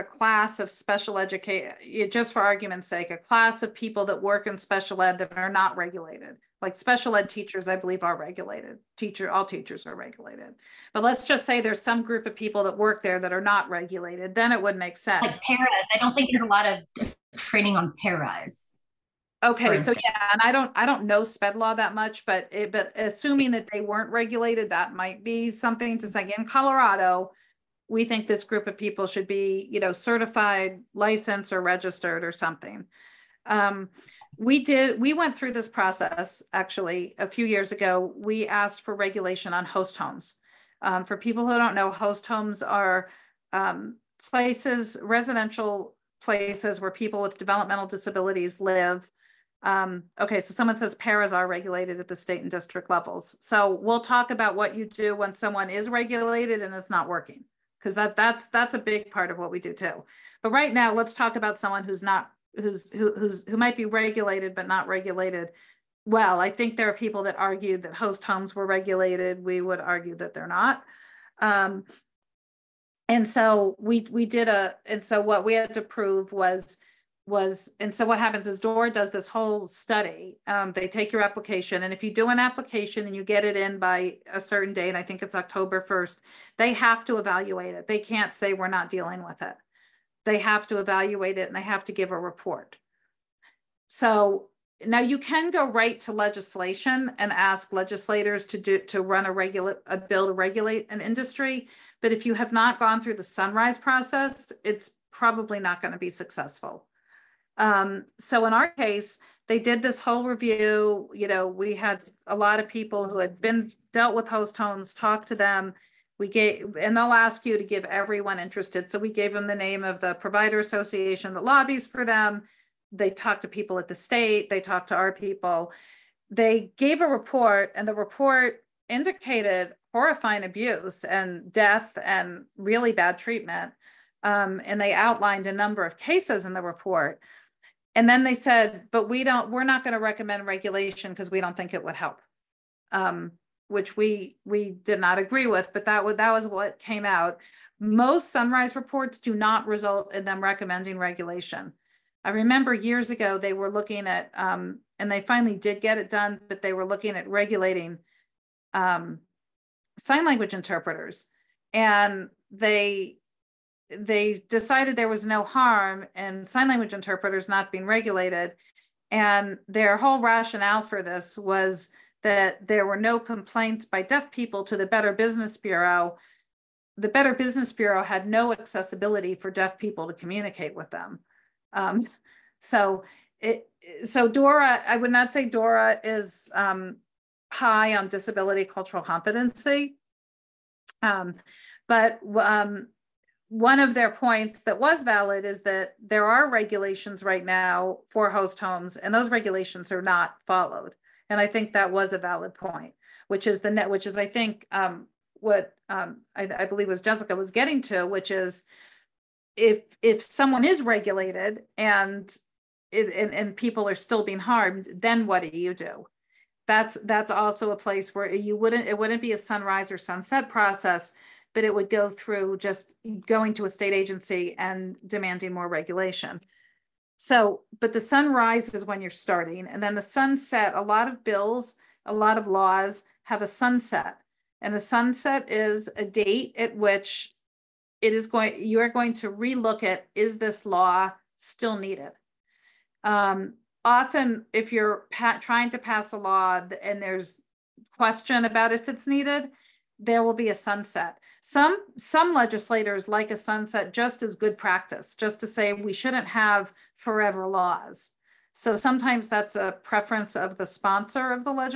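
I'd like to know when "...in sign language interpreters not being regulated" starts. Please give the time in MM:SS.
02:46.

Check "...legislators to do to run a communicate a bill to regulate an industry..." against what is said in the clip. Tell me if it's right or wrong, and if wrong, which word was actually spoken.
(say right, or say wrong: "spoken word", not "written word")
wrong: "regulate", not "communicate".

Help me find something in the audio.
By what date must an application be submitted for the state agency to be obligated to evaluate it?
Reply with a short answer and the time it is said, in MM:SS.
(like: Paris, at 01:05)
October 1st, at 01:25.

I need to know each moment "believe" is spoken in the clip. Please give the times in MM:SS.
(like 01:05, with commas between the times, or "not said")
00:07, 03:26.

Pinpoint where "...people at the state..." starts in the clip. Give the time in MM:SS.
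02:03.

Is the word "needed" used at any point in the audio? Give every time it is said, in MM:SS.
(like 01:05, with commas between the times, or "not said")
04:01, 04:09.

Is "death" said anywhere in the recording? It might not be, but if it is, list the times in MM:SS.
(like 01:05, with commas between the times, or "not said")
02:11.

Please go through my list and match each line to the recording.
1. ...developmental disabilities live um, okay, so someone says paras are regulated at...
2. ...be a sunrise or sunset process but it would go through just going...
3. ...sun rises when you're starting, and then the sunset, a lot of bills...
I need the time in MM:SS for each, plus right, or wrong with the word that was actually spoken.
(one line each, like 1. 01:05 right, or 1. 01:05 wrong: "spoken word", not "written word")
1. 00:47 right
2. 03:39 right
3. 03:47 right.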